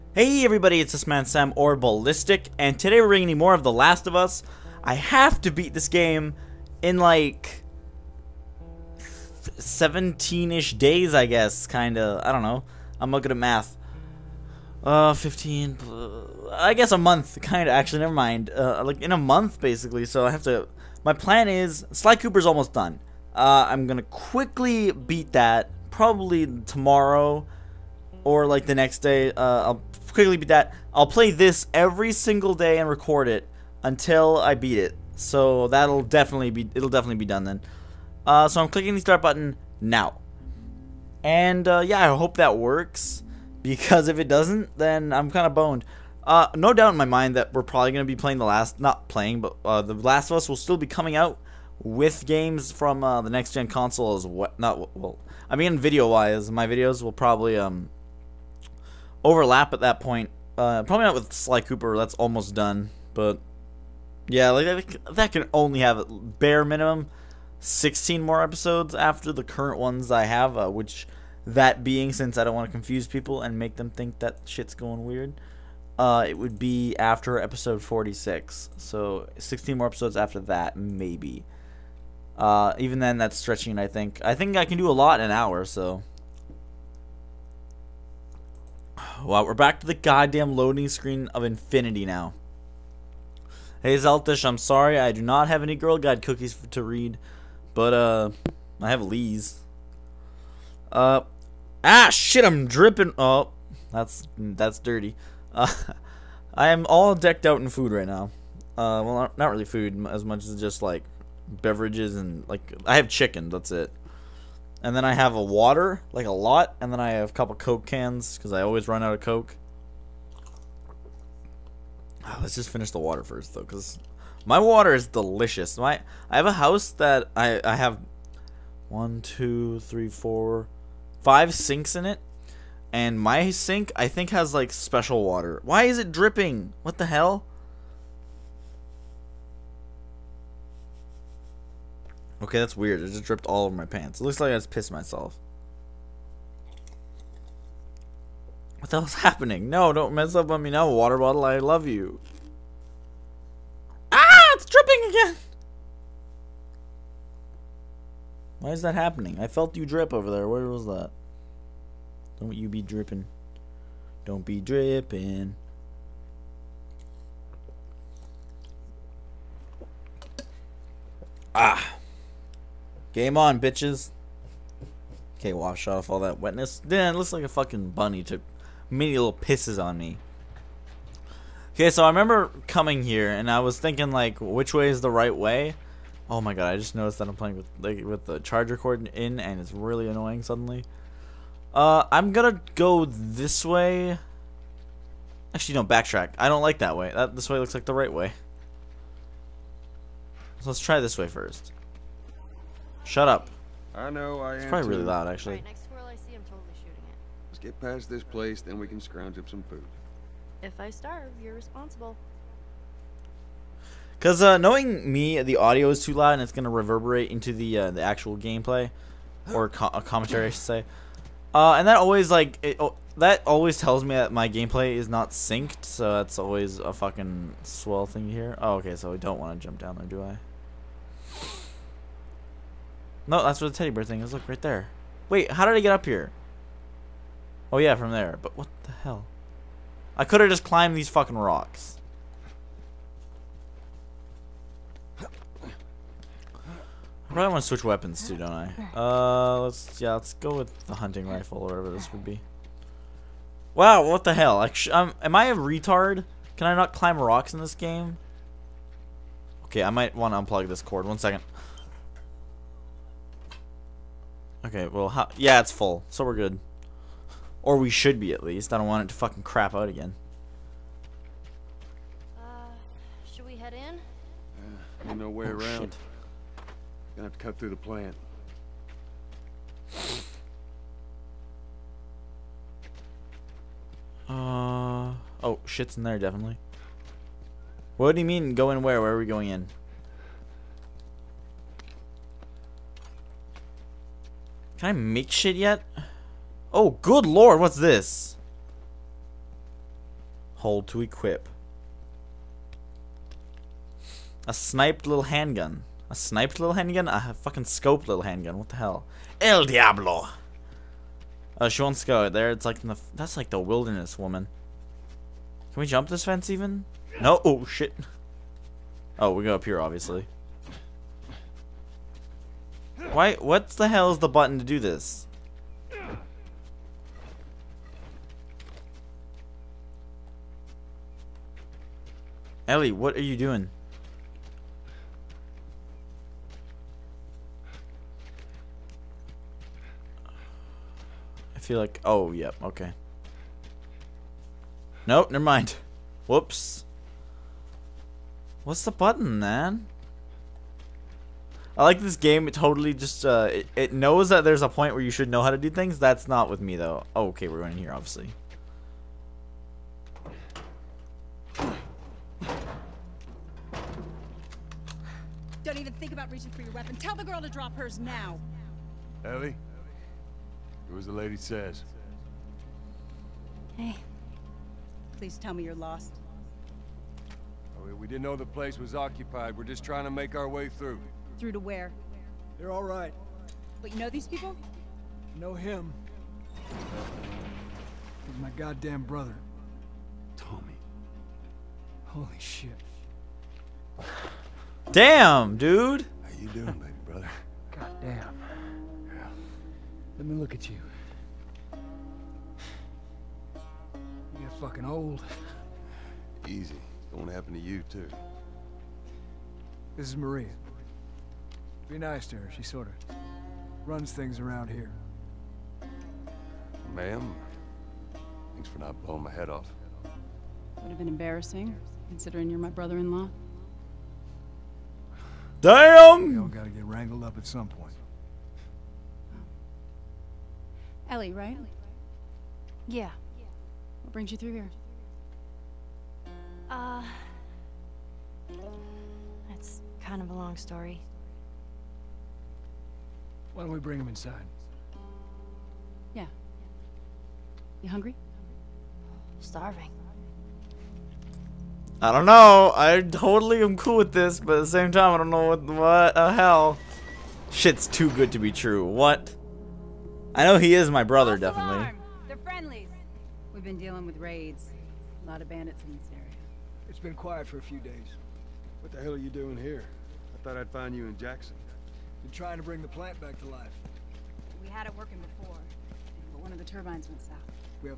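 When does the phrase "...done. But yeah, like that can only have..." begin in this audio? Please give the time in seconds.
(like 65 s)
62 s.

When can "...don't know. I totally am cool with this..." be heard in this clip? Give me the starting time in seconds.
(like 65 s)
452 s.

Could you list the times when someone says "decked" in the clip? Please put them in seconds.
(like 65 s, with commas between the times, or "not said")
107 s.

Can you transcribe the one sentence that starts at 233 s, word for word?
No, that's where the teddy bear thing is.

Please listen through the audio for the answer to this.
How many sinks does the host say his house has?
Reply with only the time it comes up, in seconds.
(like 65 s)
131 s.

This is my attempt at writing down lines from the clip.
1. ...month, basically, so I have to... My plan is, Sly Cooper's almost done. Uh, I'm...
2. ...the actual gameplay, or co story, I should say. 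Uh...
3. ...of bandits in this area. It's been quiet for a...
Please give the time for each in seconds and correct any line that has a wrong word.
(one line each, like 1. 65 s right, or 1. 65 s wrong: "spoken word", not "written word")
1. 19 s right
2. 217 s wrong: "commentary", not "story"
3. 465 s right.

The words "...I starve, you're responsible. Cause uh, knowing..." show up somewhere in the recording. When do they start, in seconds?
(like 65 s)
210 s.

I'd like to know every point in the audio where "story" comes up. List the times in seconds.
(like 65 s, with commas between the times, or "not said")
440 s.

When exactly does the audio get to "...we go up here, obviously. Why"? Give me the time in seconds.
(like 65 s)
319 s.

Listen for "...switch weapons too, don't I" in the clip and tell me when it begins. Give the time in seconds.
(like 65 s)
247 s.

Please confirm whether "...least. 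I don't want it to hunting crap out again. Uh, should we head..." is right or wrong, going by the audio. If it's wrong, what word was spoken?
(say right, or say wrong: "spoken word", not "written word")
wrong: "fucking", not "hunting".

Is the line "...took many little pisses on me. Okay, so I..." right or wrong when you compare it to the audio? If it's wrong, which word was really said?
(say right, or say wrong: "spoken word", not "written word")
right.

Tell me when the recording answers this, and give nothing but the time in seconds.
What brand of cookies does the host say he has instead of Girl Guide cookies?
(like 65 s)
99 s.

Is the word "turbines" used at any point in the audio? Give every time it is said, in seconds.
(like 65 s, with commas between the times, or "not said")
476 s.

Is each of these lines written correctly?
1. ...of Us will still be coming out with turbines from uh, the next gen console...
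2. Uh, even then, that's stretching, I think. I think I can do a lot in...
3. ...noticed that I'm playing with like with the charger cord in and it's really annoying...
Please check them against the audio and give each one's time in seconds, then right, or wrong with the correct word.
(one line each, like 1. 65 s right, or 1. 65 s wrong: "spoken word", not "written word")
1. 50 s wrong: "games", not "turbines"
2. 82 s right
3. 186 s right.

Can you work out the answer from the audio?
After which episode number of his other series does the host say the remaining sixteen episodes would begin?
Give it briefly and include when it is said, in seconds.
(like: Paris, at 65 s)
46, at 77 s.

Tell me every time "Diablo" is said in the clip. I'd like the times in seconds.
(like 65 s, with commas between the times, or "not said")
309 s.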